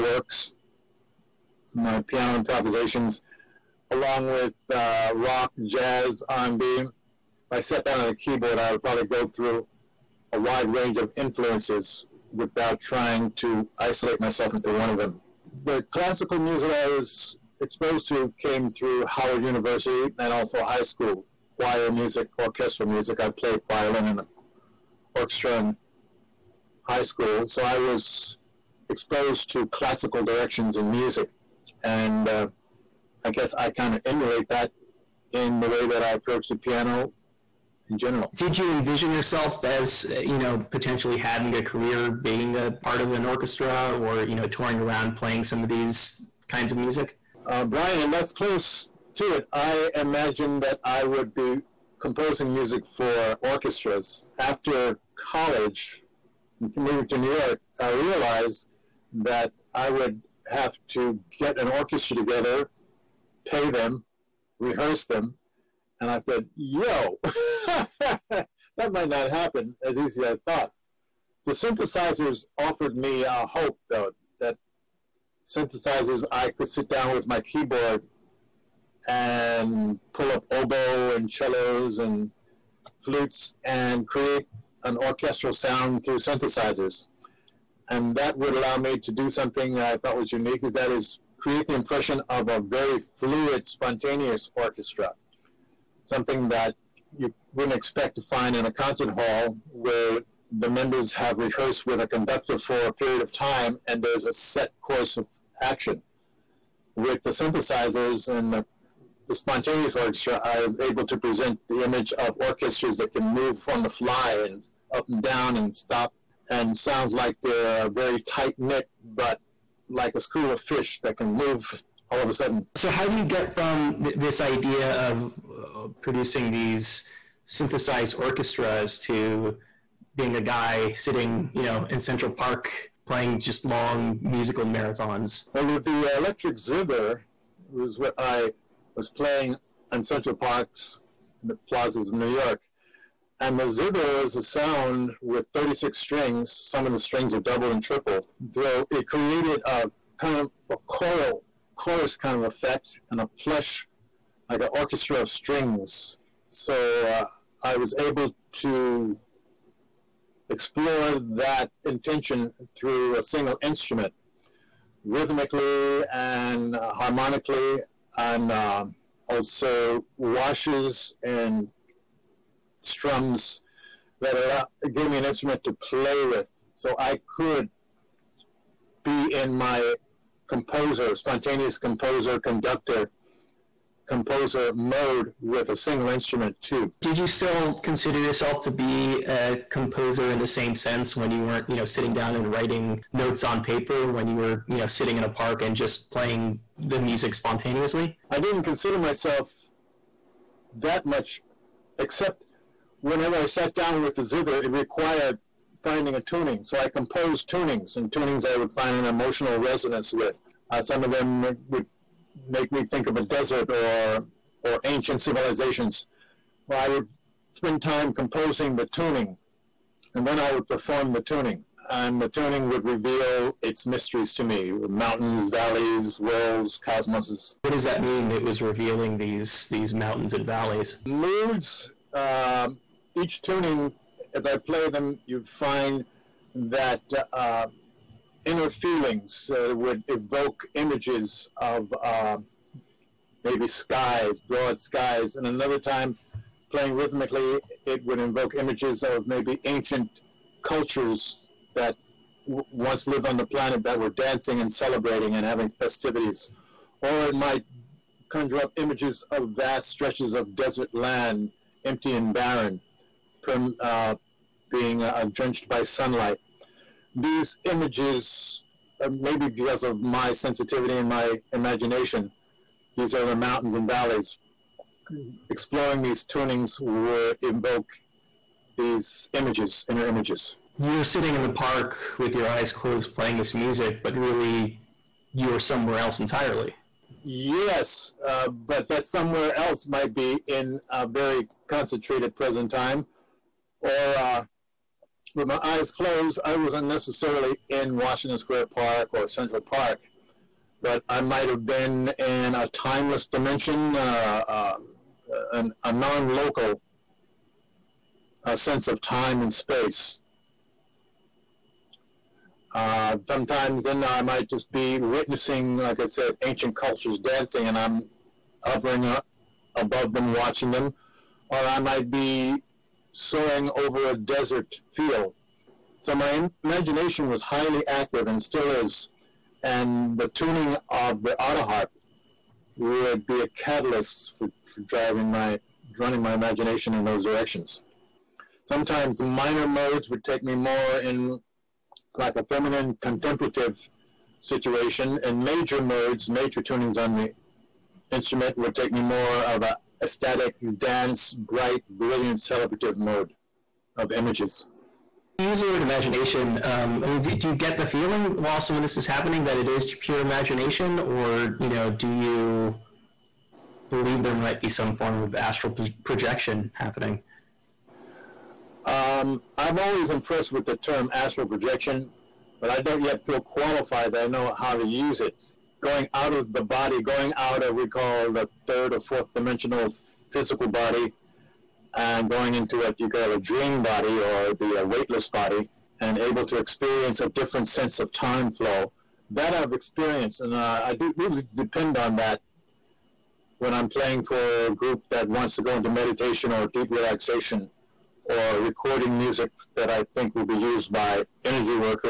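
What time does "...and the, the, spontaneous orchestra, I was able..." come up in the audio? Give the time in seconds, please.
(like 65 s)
108 s.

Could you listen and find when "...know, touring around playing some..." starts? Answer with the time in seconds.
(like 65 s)
44 s.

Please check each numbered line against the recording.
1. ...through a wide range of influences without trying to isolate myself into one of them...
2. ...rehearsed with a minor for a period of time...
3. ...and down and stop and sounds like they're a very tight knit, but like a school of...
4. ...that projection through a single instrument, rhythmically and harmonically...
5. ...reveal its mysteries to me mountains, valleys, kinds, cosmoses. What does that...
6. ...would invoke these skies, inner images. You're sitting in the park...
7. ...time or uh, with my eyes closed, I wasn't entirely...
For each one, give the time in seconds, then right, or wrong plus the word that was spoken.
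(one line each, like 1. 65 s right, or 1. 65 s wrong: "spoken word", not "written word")
1. 9 s right
2. 101 s wrong: "conductor", not "minor"
3. 115 s right
4. 161 s wrong: "intention", not "projection"
5. 222 s wrong: "worlds", not "kinds"
6. 276 s wrong: "images", not "skies"
7. 292 s wrong: "necessarily", not "entirely".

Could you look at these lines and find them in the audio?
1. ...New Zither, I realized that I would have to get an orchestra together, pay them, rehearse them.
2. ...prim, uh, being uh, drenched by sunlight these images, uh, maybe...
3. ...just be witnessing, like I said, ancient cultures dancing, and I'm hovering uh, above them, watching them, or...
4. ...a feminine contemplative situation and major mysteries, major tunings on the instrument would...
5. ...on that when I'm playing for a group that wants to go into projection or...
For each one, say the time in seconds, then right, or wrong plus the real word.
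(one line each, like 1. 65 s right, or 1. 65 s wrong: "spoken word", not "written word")
1. 57 s wrong: "York", not "Zither"
2. 263 s right
3. 314 s right
4. 342 s wrong: "modes", not "mysteries"
5. 391 s wrong: "meditation", not "projection".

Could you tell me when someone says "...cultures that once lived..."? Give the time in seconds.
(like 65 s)
250 s.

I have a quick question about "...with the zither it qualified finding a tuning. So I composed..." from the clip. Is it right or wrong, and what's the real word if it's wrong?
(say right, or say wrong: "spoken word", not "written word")
wrong: "required", not "qualified".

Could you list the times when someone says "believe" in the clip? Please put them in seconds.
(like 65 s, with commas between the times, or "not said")
363 s.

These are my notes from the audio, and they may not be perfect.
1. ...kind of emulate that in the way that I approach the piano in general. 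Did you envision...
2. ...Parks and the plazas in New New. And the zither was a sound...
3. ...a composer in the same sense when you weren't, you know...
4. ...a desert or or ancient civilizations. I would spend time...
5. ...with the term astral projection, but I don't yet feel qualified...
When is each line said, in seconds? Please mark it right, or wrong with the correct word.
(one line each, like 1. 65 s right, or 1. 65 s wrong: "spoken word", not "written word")
1. 33 s right
2. 140 s wrong: "York", not "New"
3. 189 s right
4. 213 s right
5. 370 s right.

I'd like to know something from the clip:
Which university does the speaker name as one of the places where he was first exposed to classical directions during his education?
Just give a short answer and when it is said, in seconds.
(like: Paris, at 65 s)
Howard University, at 19 s.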